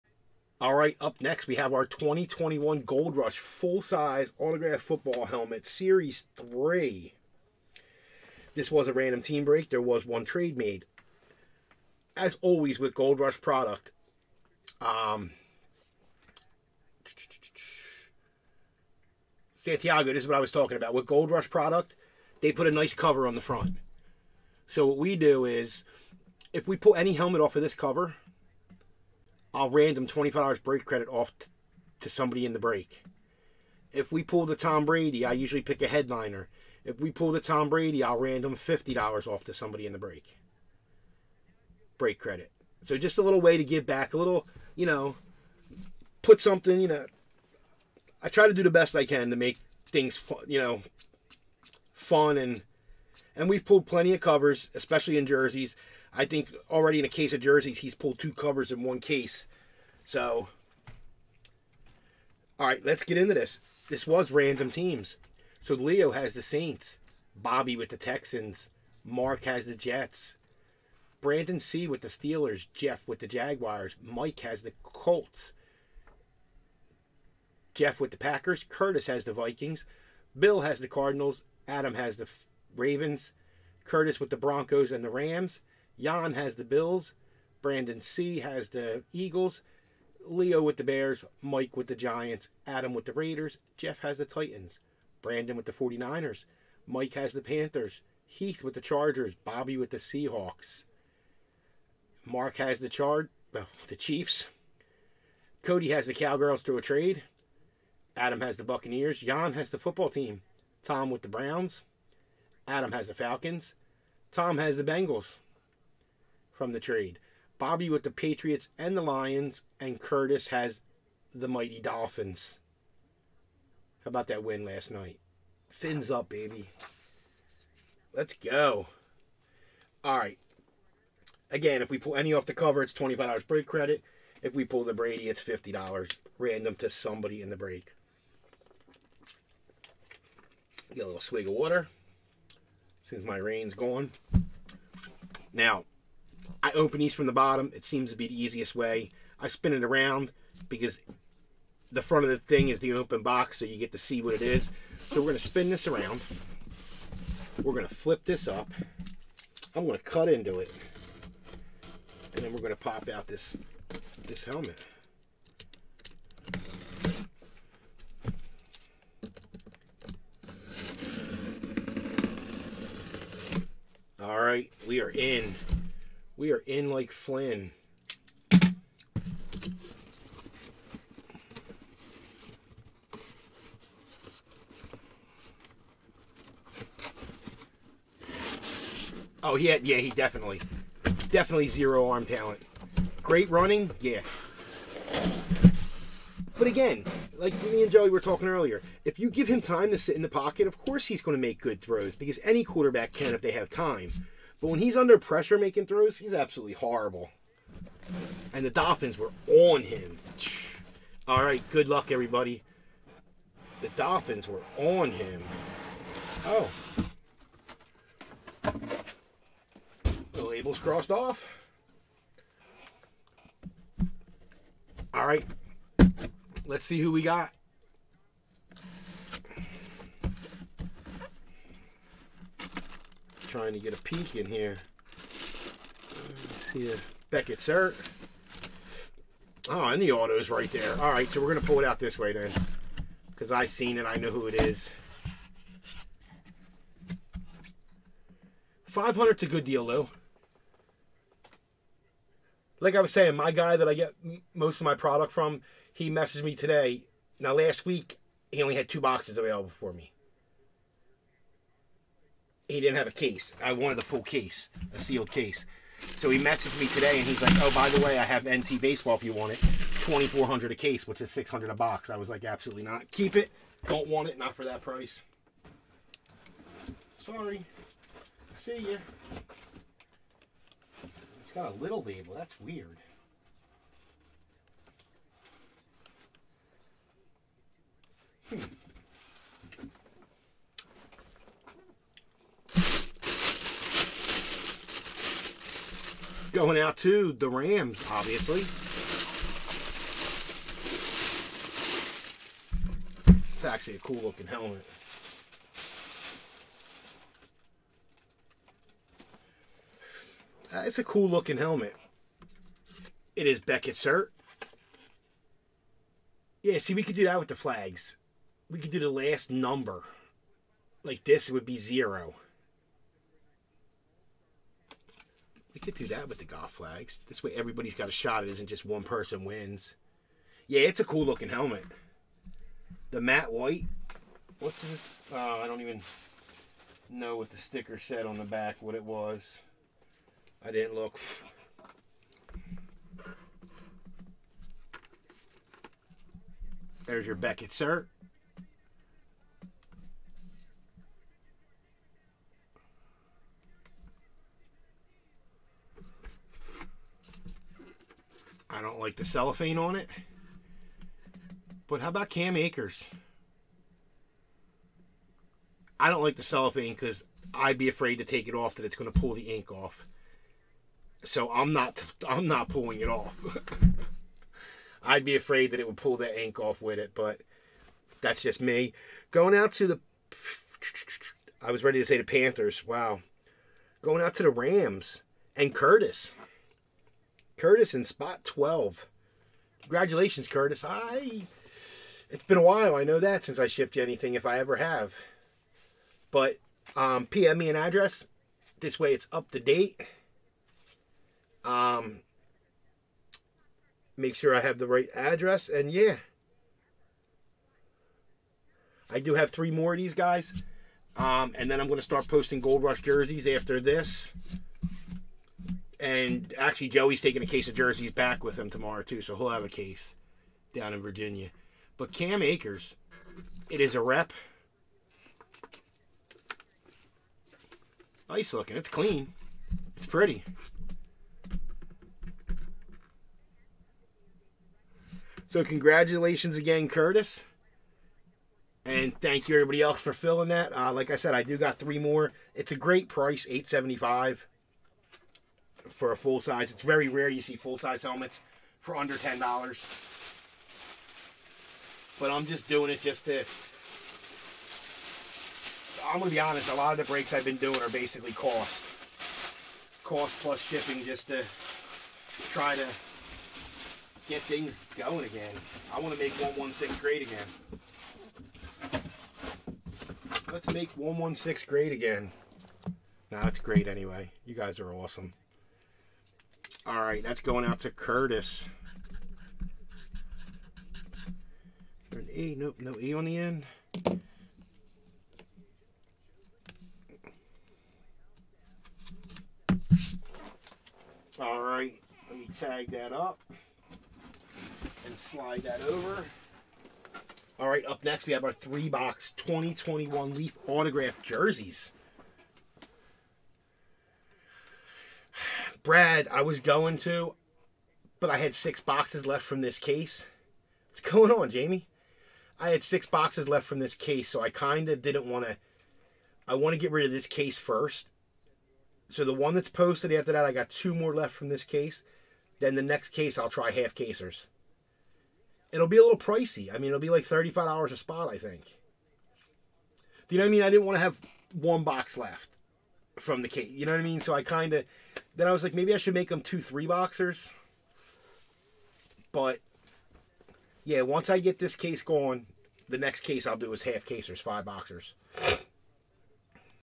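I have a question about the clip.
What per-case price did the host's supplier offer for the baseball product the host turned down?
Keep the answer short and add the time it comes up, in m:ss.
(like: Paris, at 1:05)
2400, at 4:29.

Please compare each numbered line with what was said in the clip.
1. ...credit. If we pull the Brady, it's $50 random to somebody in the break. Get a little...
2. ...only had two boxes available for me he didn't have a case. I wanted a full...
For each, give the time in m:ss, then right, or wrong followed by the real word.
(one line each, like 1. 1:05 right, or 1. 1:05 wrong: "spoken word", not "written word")
1. 2:13 right
2. 4:18 right.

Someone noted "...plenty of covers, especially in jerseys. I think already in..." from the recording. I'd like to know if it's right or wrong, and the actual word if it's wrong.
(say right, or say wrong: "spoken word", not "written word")
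right.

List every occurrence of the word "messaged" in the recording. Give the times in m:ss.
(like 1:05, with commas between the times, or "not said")
4:16, 4:26.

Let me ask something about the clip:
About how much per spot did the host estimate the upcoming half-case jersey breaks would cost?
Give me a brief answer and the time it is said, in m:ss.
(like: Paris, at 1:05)
$35, at 8:47.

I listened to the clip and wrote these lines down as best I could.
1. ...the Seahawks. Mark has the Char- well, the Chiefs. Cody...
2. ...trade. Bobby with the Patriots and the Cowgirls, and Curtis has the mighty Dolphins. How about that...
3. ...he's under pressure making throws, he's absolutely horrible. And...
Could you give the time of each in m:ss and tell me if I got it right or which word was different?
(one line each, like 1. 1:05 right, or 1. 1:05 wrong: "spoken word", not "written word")
1. 1:39 right
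2. 1:56 wrong: "Lions", not "Cowgirls"
3. 3:24 right.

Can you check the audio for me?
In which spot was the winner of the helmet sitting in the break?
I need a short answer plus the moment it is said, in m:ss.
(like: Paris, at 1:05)
12, at 6:28.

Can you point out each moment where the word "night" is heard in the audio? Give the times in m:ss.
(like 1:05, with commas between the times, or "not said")
2:04.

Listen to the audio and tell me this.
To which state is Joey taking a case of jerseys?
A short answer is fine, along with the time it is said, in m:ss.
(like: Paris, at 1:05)
Virginia, at 7:01.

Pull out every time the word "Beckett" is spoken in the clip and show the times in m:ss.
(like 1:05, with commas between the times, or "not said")
3:57, 5:13, 5:47.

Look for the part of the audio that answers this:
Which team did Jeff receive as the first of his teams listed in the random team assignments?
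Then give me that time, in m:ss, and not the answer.
1:13.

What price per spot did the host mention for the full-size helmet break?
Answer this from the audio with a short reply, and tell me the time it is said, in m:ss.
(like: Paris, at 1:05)
$8.75, at 7:23.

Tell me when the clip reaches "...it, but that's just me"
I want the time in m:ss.
6:16.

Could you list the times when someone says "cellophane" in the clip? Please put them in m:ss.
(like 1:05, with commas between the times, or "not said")
5:59, 6:06.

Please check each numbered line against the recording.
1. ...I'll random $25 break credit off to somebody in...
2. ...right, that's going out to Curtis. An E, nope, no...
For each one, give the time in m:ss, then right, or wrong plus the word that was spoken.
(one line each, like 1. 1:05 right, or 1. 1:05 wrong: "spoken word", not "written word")
1. 0:29 right
2. 7:56 right.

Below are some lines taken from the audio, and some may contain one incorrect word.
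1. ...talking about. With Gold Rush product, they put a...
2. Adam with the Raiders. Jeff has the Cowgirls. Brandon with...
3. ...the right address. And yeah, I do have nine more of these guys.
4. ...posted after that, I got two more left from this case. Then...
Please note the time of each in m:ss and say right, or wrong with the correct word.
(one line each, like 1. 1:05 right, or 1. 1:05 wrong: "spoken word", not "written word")
1. 0:20 right
2. 1:32 wrong: "Titans", not "Cowgirls"
3. 6:44 wrong: "three", not "nine"
4. 8:39 right.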